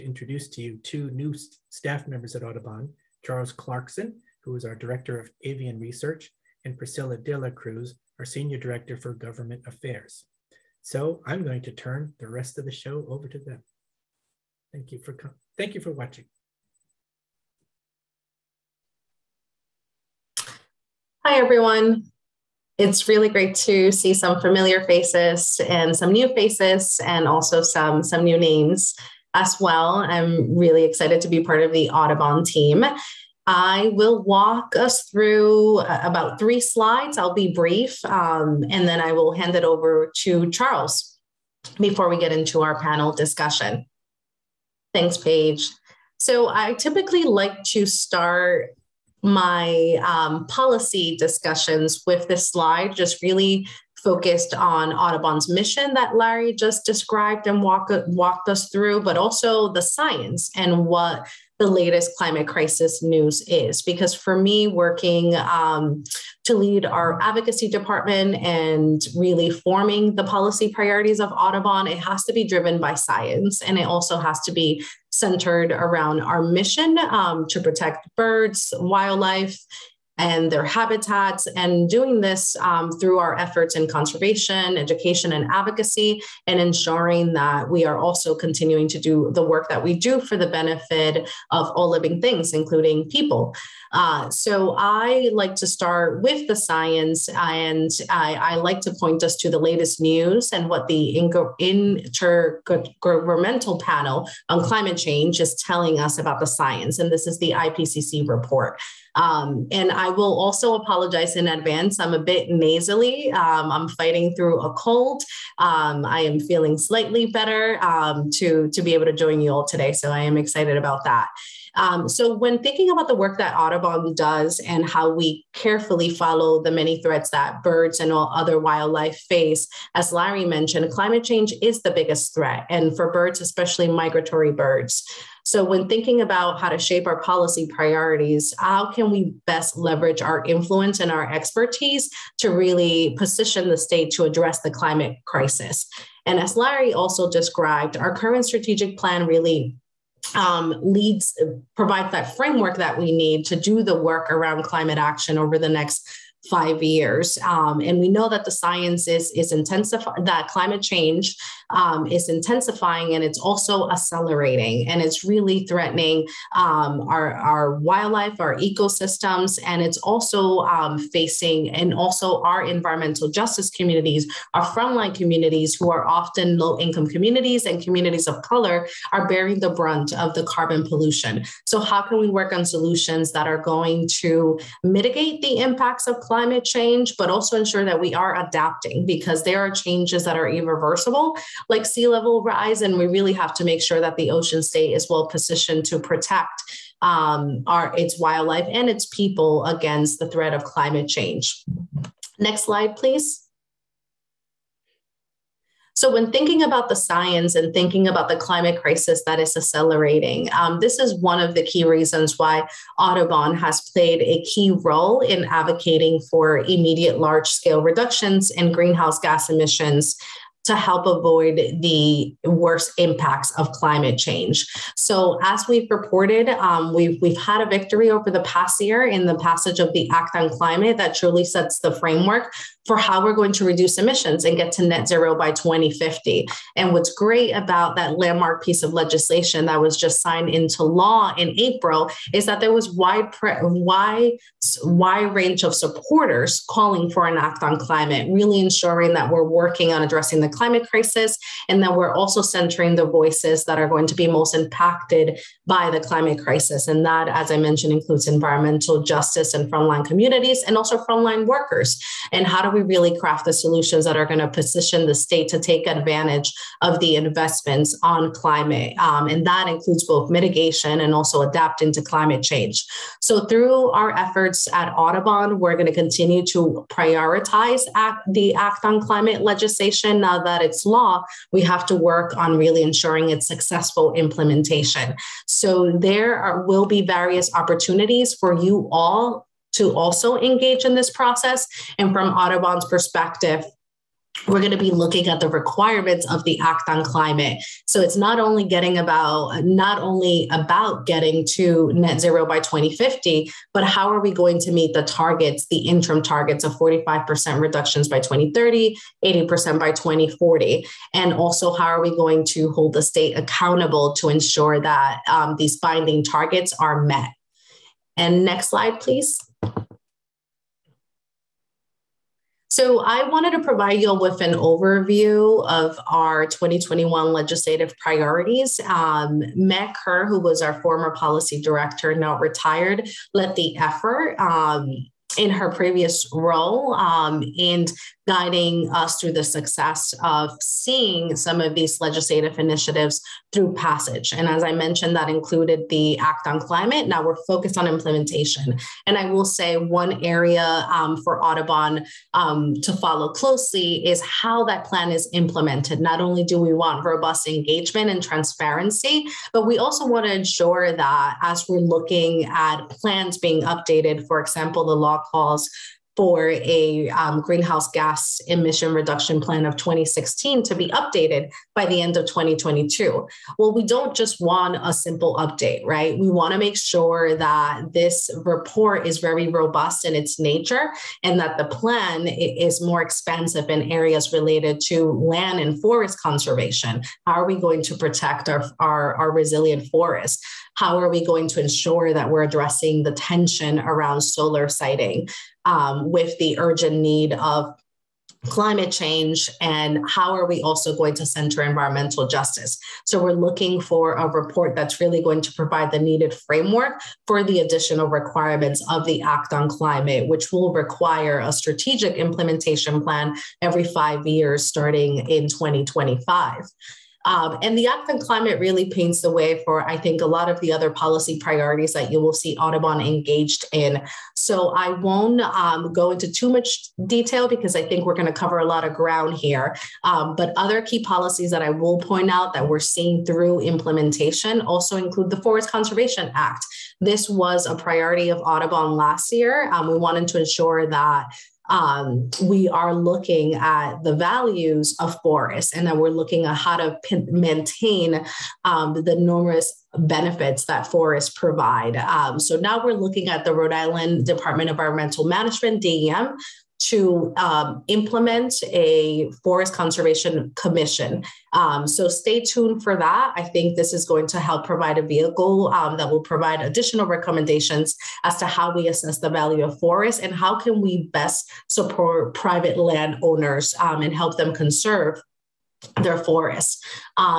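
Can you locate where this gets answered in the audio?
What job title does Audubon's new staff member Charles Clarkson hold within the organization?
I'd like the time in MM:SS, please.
00:04.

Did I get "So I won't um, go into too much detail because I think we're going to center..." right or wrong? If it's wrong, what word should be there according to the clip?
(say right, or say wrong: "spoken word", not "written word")
wrong: "cover", not "center".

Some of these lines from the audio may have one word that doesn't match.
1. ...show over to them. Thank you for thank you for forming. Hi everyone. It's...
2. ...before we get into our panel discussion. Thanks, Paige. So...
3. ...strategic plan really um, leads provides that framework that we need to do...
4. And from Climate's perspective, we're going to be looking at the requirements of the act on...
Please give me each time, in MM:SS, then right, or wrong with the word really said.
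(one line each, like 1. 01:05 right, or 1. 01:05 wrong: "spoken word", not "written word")
1. 00:12 wrong: "watching", not "forming"
2. 00:41 right
3. 02:28 right
4. 04:51 wrong: "Audubon", not "Climate".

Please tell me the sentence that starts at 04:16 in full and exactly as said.
And that, as I mentioned, includes environmental justice and frontline communities and also frontline workers.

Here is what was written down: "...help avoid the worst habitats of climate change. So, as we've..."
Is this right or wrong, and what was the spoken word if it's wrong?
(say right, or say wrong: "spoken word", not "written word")
wrong: "impacts", not "habitats".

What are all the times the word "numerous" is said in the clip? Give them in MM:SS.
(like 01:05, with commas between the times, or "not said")
07:29.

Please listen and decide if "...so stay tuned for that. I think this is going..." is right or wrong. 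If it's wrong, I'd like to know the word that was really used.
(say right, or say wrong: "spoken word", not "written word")
right.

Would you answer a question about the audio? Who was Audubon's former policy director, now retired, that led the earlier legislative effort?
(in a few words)
Meg Kerr.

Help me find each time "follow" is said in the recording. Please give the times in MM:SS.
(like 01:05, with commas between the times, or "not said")
02:06, 05:52.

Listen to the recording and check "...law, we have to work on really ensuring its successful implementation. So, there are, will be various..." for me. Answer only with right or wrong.
right.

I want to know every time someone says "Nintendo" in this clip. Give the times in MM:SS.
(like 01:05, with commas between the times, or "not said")
not said.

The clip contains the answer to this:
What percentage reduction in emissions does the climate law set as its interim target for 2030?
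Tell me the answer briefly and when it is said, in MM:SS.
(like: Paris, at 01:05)
45%, at 05:06.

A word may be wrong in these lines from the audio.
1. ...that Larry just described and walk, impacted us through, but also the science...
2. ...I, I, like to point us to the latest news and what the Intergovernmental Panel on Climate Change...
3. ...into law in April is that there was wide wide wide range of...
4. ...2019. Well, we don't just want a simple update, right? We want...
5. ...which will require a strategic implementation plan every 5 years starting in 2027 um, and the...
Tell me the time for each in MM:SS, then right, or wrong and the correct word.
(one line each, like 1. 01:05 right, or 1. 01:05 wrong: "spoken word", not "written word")
1. 00:55 wrong: "walked", not "impacted"
2. 01:38 right
3. 04:00 right
4. 06:12 wrong: "2022", not "2019"
5. 06:50 wrong: "2025", not "2027".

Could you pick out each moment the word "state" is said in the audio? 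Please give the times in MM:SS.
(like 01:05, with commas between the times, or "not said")
02:23, 03:14, 04:25, 05:13.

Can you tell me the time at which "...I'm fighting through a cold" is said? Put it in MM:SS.
01:53.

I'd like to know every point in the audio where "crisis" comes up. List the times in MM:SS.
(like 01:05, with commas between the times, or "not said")
01:02, 02:25, 03:28, 04:10, 04:16.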